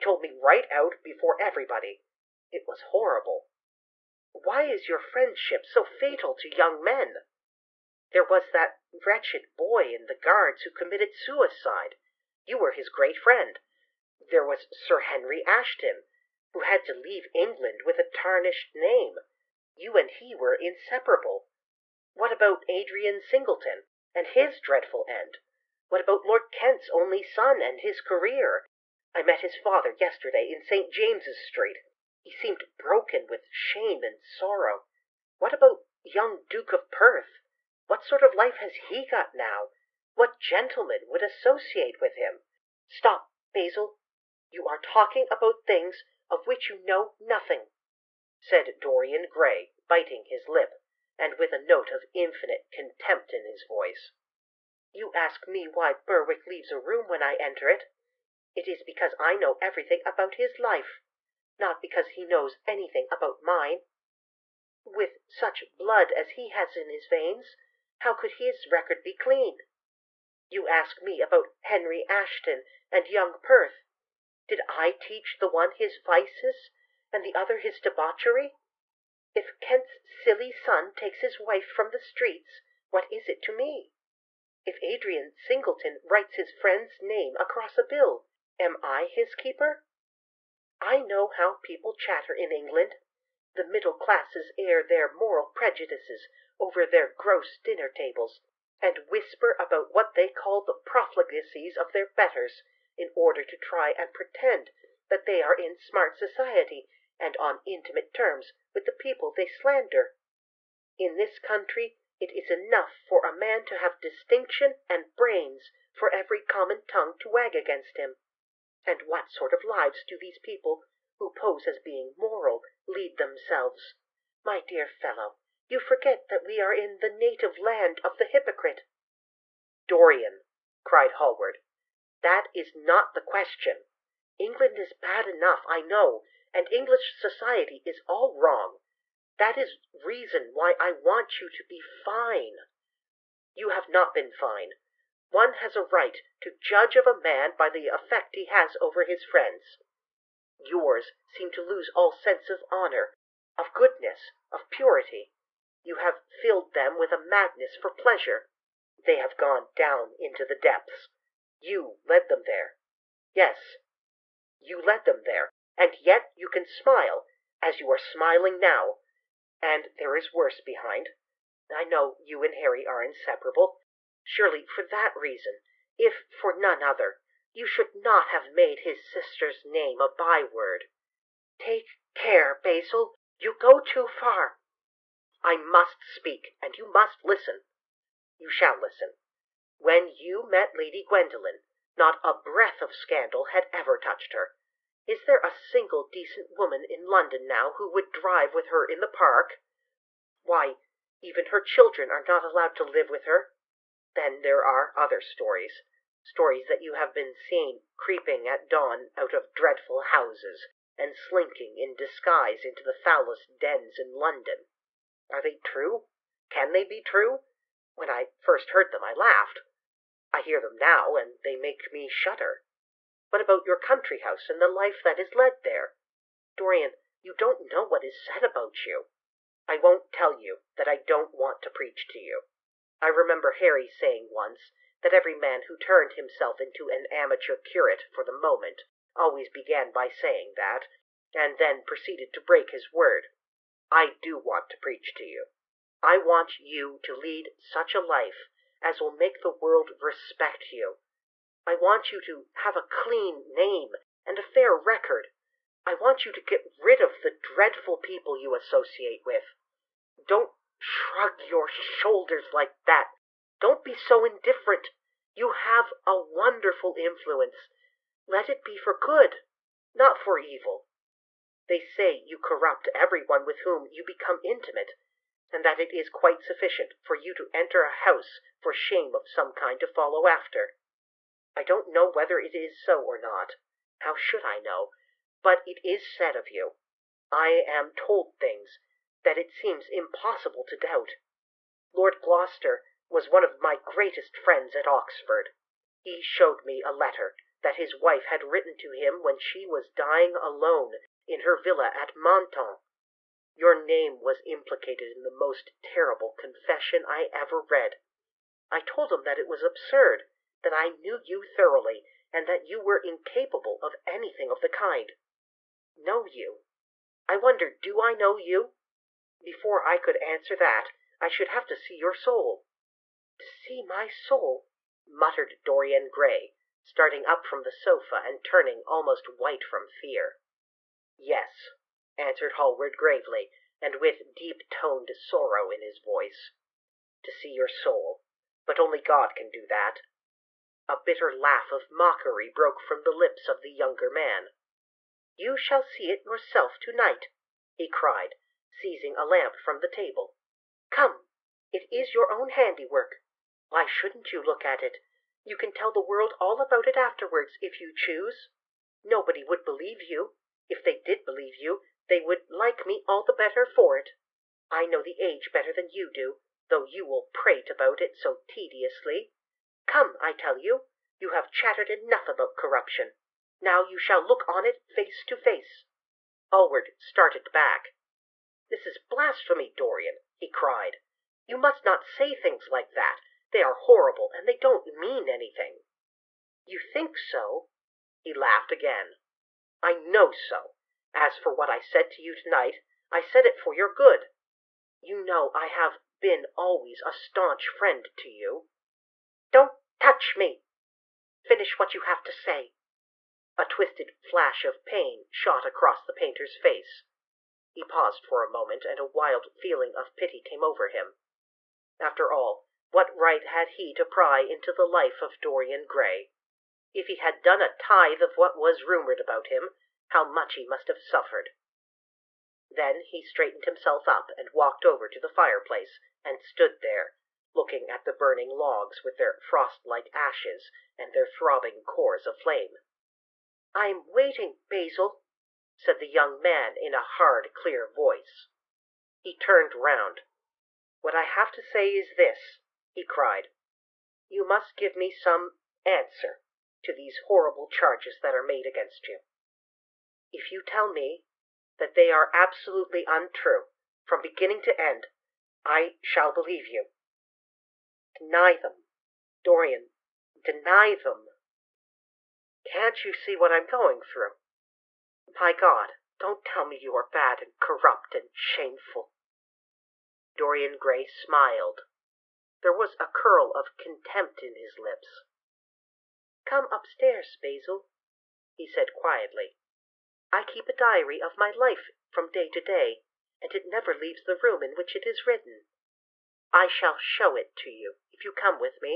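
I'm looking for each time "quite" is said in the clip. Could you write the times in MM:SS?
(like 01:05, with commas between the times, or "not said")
04:36.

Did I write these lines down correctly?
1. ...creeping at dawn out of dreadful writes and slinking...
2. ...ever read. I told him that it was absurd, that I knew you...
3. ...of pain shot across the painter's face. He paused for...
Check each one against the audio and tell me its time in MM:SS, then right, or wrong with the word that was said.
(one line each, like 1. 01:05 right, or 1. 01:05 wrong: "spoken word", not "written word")
1. 03:27 wrong: "houses", not "writes"
2. 05:07 right
3. 06:44 right.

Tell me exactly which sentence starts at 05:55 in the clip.
You can tell the world all about it afterwards if you choose.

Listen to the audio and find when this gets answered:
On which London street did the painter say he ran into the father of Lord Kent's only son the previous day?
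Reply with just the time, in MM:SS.
00:30.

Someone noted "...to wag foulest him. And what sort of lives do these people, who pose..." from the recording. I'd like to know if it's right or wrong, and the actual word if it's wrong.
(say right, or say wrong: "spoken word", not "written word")
wrong: "against", not "foulest".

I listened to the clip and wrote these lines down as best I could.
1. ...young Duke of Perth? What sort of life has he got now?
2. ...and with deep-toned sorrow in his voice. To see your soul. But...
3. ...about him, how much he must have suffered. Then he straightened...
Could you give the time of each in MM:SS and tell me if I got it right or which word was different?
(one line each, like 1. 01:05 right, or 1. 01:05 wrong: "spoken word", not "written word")
1. 00:36 right
2. 05:33 right
3. 06:59 right.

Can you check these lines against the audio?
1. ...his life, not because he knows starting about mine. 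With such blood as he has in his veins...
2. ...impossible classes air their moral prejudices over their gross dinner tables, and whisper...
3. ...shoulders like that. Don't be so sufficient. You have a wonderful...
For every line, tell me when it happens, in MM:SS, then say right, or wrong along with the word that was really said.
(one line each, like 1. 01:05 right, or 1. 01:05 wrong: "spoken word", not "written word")
1. 01:00 wrong: "anything", not "starting"
2. 01:33 wrong: "middle", not "impossible"
3. 04:21 wrong: "indifferent", not "sufficient".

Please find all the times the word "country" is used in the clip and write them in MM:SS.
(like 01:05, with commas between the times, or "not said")
01:51, 03:43.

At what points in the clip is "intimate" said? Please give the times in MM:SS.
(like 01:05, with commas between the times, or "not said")
01:47, 04:34.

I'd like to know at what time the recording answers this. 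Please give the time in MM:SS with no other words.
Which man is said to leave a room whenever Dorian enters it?
00:55.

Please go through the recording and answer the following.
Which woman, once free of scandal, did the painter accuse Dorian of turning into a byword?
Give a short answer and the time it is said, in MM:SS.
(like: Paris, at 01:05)
Lady Gwendolen, at 03:10.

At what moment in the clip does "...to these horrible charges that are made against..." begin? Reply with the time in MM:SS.
07:26.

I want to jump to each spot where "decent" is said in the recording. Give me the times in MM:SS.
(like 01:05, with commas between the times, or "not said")
03:16.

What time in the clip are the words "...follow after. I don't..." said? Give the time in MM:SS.
04:39.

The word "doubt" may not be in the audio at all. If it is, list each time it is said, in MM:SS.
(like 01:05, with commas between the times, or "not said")
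04:50.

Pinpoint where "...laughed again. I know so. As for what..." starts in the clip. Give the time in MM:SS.
06:28.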